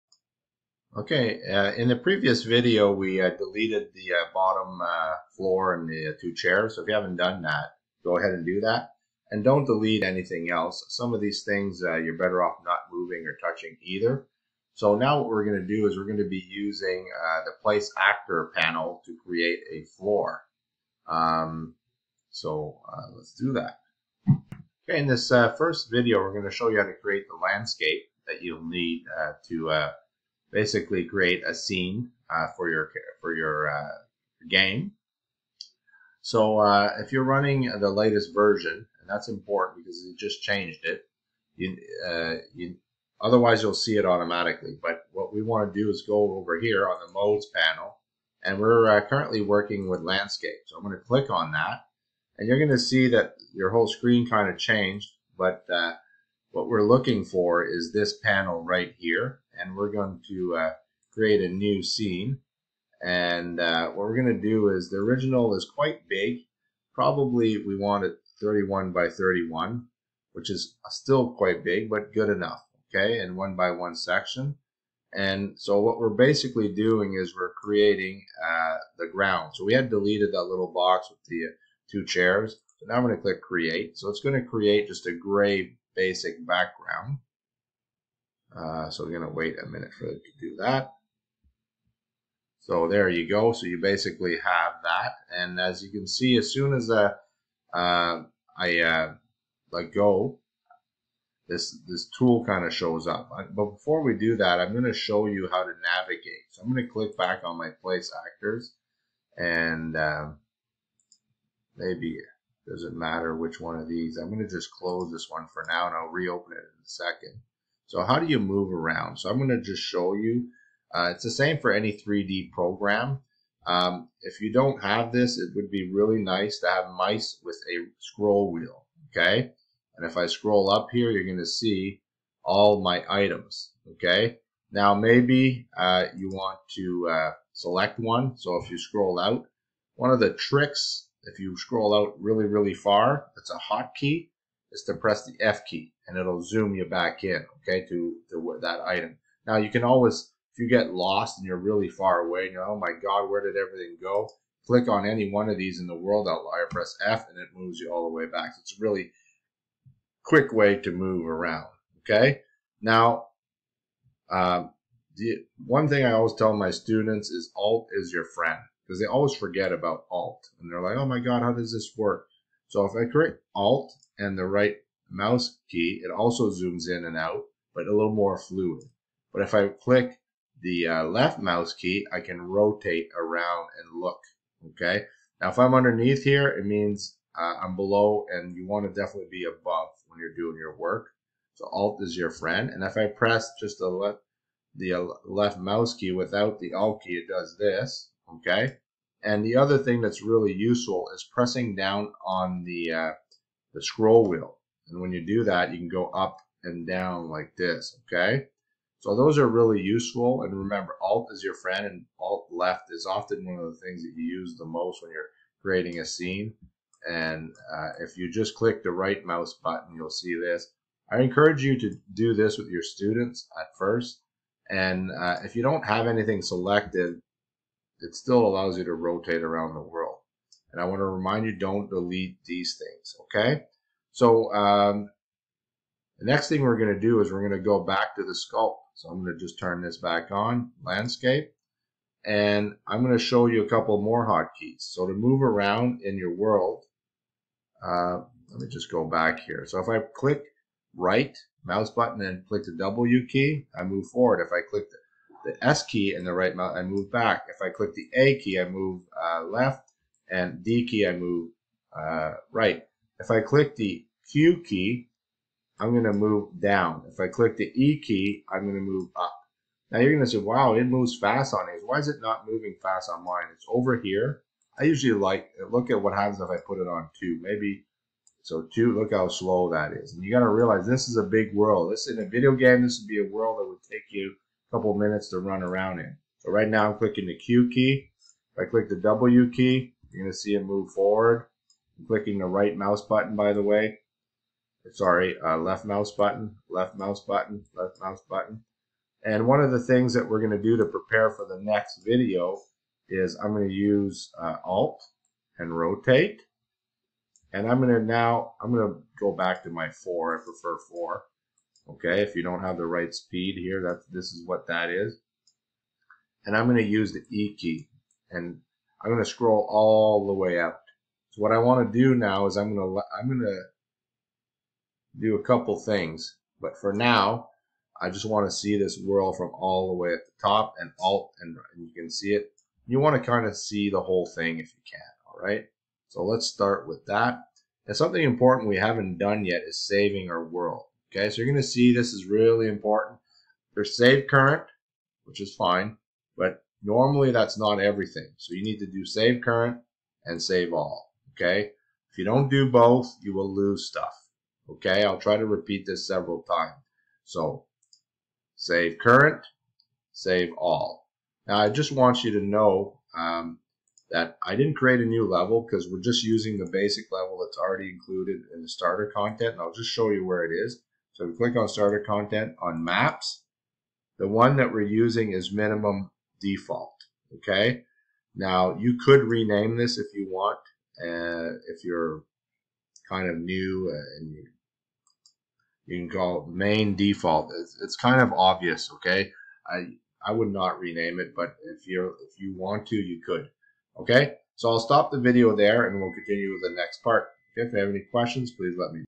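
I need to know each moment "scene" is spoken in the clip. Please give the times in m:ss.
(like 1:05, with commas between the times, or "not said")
0:31, 1:01, 3:36.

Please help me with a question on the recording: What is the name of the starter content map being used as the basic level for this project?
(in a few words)
Minimum Default.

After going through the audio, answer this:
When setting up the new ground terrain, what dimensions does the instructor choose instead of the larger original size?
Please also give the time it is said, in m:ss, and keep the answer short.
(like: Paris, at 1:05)
31 by 31, at 1:08.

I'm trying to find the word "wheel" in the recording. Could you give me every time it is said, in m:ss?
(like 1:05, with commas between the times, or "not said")
2:08, 3:24.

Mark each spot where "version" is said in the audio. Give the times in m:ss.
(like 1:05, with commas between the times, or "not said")
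0:38.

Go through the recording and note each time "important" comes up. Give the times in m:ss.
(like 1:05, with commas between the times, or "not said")
0:39, 5:38, 5:42.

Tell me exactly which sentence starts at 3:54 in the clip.
So um, the next thing we're going to do is we're going to go back to the sculpt.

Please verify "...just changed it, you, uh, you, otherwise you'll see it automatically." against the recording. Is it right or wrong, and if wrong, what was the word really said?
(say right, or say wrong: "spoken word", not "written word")
right.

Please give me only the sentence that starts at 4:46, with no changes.
So right now I'm clicking the Q key.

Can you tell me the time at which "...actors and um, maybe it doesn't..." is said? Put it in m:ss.
1:48.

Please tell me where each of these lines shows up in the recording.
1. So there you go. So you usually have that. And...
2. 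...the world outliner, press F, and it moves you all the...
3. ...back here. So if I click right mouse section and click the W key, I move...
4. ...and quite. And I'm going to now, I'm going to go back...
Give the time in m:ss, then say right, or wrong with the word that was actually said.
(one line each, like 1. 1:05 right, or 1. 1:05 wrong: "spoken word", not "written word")
1. 1:32 wrong: "basically", not "usually"
2. 2:35 right
3. 4:09 wrong: "button", not "section"
4. 5:05 wrong: "rotate", not "quite".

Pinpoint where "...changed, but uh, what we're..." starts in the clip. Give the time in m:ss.
0:54.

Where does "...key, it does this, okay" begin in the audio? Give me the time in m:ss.
3:17.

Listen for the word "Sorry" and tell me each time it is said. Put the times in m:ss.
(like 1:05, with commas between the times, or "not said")
4:54.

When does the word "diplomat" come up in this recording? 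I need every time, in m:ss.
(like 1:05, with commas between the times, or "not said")
not said.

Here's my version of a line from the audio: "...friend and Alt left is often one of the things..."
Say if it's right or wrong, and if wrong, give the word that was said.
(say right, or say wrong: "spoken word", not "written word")
right.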